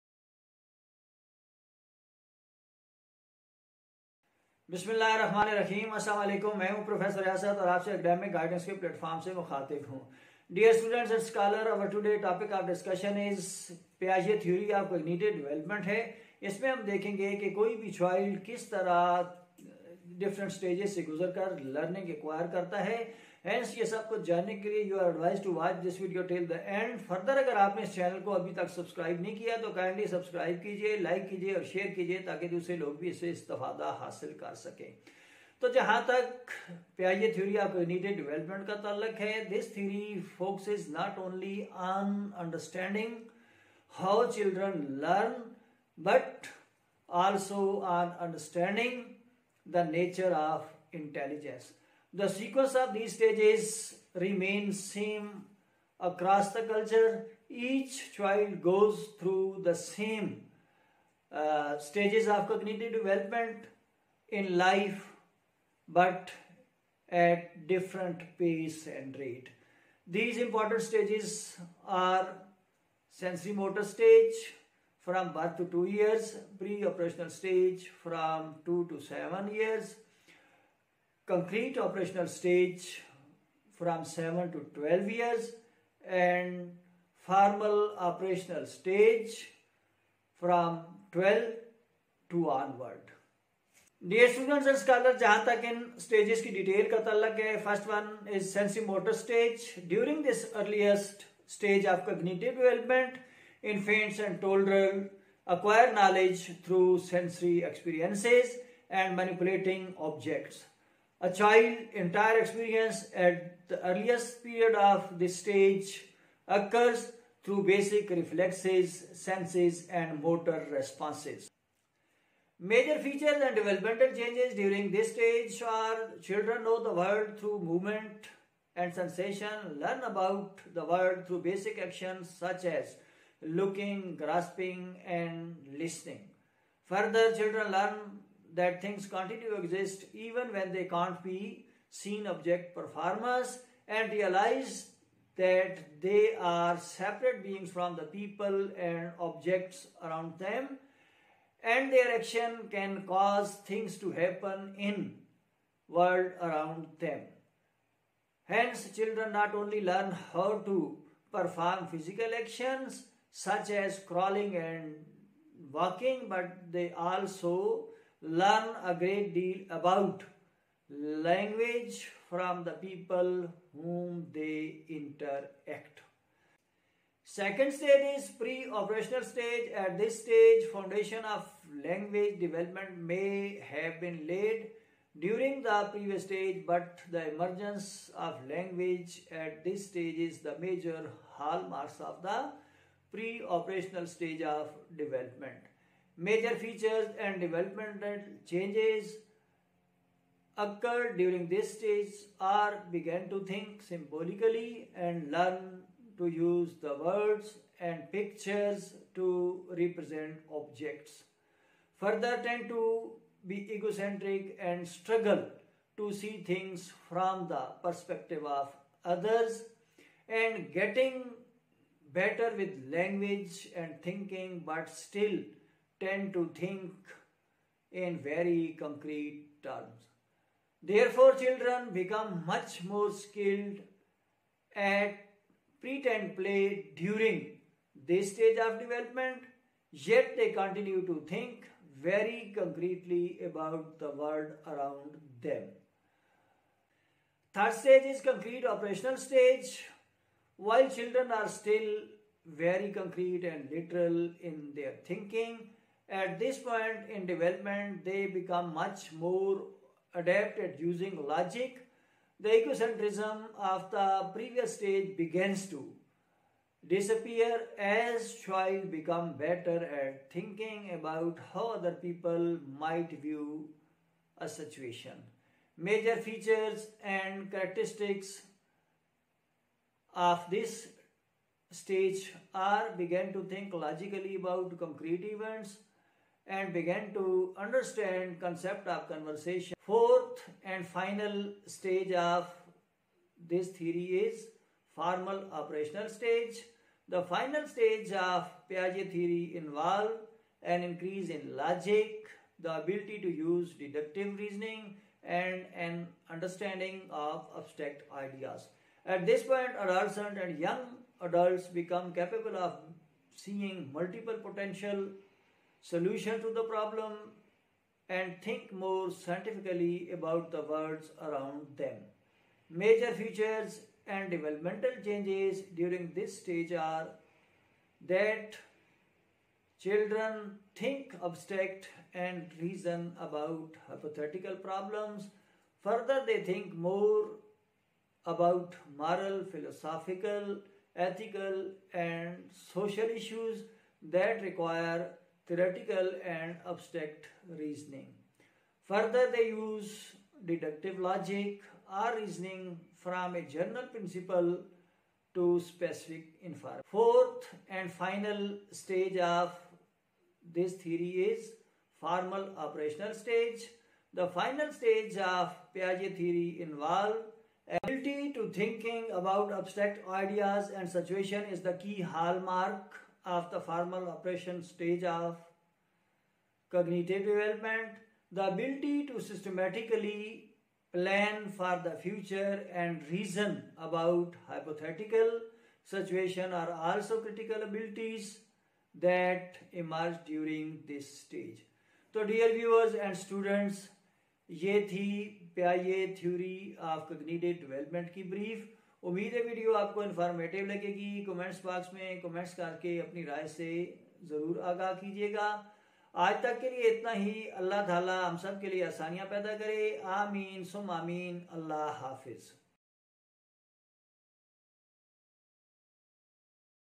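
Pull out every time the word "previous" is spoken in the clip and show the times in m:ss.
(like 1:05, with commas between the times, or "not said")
3:05, 4:24.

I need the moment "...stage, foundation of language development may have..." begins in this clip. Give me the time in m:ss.
3:00.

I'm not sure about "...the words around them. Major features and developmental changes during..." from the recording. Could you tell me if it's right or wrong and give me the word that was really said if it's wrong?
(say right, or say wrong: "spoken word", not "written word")
right.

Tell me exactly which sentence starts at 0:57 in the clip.
Each child goes through the same uh, stages of cognitive development in life, but at different pace and rate.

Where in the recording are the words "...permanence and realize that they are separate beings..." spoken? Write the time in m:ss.
2:22.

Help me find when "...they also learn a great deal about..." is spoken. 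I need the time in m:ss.
2:46.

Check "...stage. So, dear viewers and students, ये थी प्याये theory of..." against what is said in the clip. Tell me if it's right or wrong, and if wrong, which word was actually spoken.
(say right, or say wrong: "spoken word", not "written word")
right.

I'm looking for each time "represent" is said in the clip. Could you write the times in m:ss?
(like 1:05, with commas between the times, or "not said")
3:29.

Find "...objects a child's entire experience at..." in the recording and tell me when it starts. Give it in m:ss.
1:49.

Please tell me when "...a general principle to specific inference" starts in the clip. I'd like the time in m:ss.
5:53.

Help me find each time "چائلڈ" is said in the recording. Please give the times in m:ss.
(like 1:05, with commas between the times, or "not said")
0:17.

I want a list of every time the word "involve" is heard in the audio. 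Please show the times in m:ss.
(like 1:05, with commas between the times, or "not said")
4:59, 6:06.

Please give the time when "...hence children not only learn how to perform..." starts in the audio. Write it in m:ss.
2:38.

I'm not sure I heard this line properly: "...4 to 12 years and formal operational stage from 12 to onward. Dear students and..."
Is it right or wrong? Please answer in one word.
wrong.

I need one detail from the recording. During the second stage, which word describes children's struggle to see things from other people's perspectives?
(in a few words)
egocentric.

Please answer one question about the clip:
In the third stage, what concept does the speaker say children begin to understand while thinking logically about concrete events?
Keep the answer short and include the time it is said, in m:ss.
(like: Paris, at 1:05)
conversation, at 4:49.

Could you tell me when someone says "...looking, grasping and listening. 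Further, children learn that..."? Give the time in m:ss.
2:13.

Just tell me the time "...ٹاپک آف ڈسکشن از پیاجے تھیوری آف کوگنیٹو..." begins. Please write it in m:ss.
0:12.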